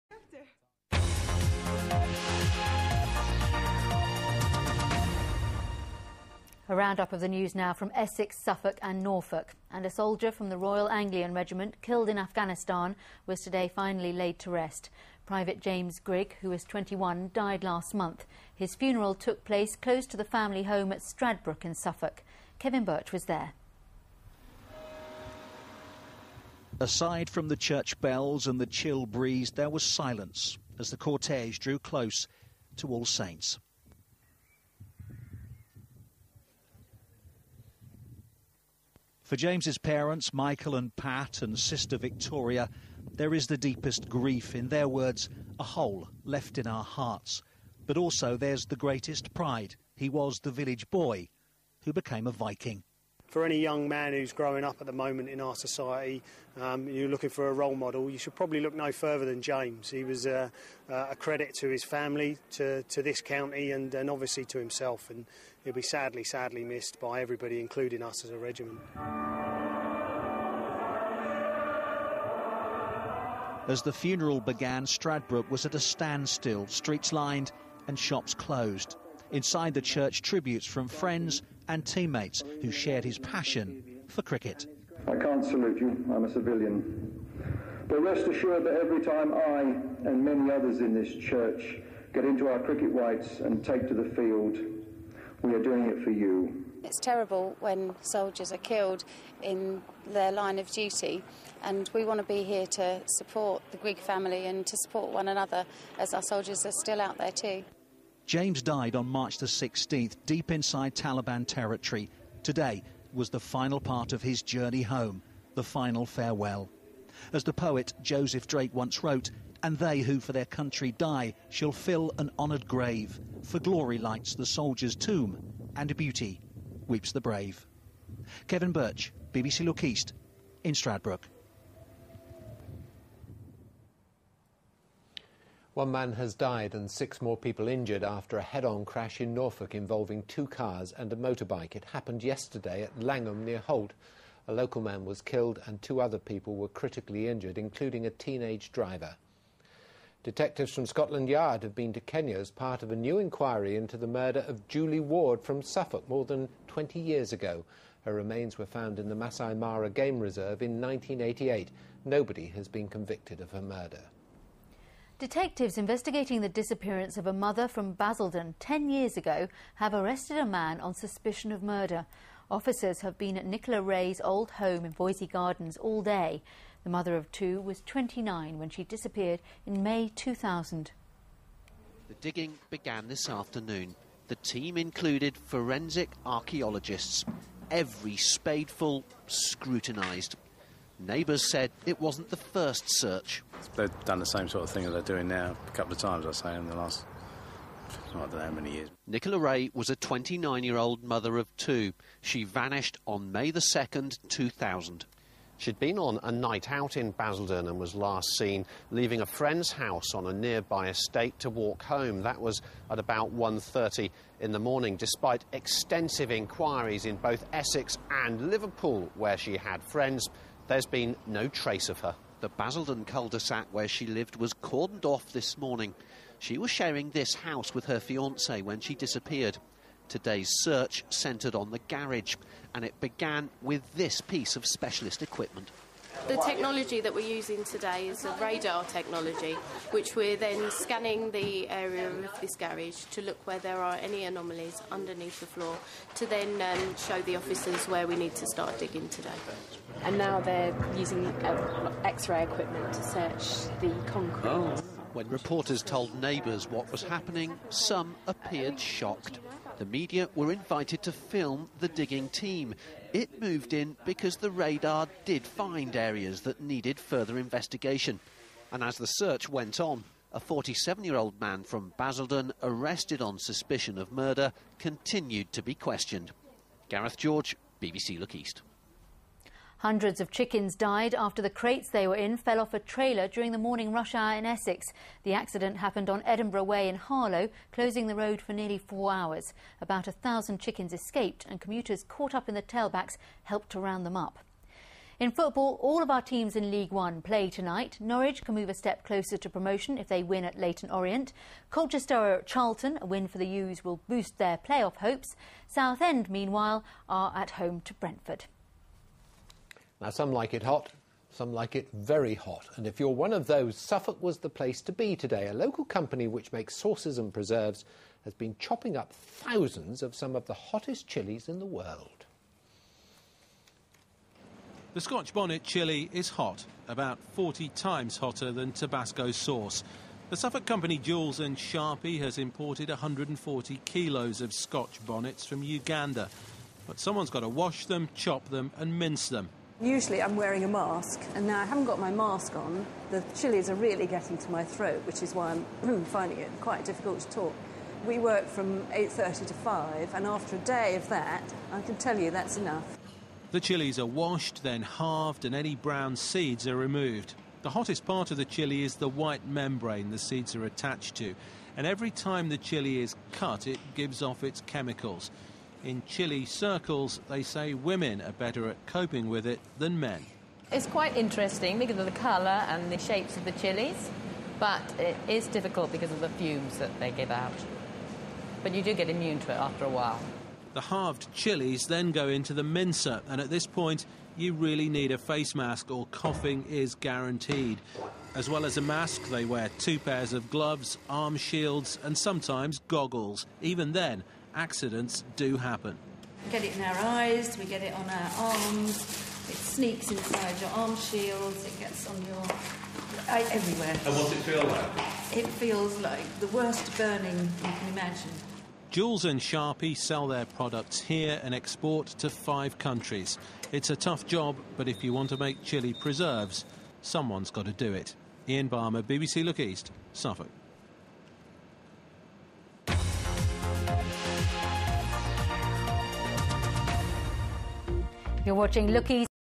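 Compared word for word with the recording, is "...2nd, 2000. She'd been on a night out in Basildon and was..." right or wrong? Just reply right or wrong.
right.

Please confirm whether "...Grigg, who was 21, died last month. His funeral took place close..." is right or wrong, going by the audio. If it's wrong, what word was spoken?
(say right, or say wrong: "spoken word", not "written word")
right.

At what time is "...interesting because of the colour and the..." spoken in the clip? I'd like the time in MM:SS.
06:11.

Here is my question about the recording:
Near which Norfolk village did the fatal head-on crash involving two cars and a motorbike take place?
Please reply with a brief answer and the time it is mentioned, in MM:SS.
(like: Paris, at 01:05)
Langham, at 02:23.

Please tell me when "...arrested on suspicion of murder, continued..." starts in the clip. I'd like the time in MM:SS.
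04:32.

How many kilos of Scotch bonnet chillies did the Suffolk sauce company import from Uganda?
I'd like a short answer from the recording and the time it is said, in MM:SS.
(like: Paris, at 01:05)
140, at 05:32.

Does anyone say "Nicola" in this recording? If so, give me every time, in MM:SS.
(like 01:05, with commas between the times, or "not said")
02:53, 03:19.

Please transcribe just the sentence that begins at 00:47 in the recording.
But also there's the greatest pride.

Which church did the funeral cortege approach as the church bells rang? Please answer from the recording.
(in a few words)
All Saints.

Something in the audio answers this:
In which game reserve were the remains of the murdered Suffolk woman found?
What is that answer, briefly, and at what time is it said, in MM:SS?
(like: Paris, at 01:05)
Masai Mara, at 02:39.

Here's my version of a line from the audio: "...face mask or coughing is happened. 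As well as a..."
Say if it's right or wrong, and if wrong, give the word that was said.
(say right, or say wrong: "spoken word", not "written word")
wrong: "guaranteed", not "happened".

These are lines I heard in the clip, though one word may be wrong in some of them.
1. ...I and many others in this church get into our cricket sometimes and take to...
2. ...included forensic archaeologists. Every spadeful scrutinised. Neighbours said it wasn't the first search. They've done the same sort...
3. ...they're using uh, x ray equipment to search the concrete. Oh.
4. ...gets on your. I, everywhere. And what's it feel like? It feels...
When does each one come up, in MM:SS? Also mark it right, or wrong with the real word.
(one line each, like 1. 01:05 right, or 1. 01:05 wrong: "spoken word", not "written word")
1. 01:29 wrong: "whites", not "sometimes"
2. 03:04 right
3. 04:10 right
4. 06:41 right.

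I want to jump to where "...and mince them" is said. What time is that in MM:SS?
05:38.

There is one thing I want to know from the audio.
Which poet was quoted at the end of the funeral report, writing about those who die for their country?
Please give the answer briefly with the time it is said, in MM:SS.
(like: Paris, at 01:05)
Joseph Drake, at 01:58.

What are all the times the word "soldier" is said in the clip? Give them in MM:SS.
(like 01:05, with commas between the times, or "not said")
00:09, 01:38, 01:46, 02:04.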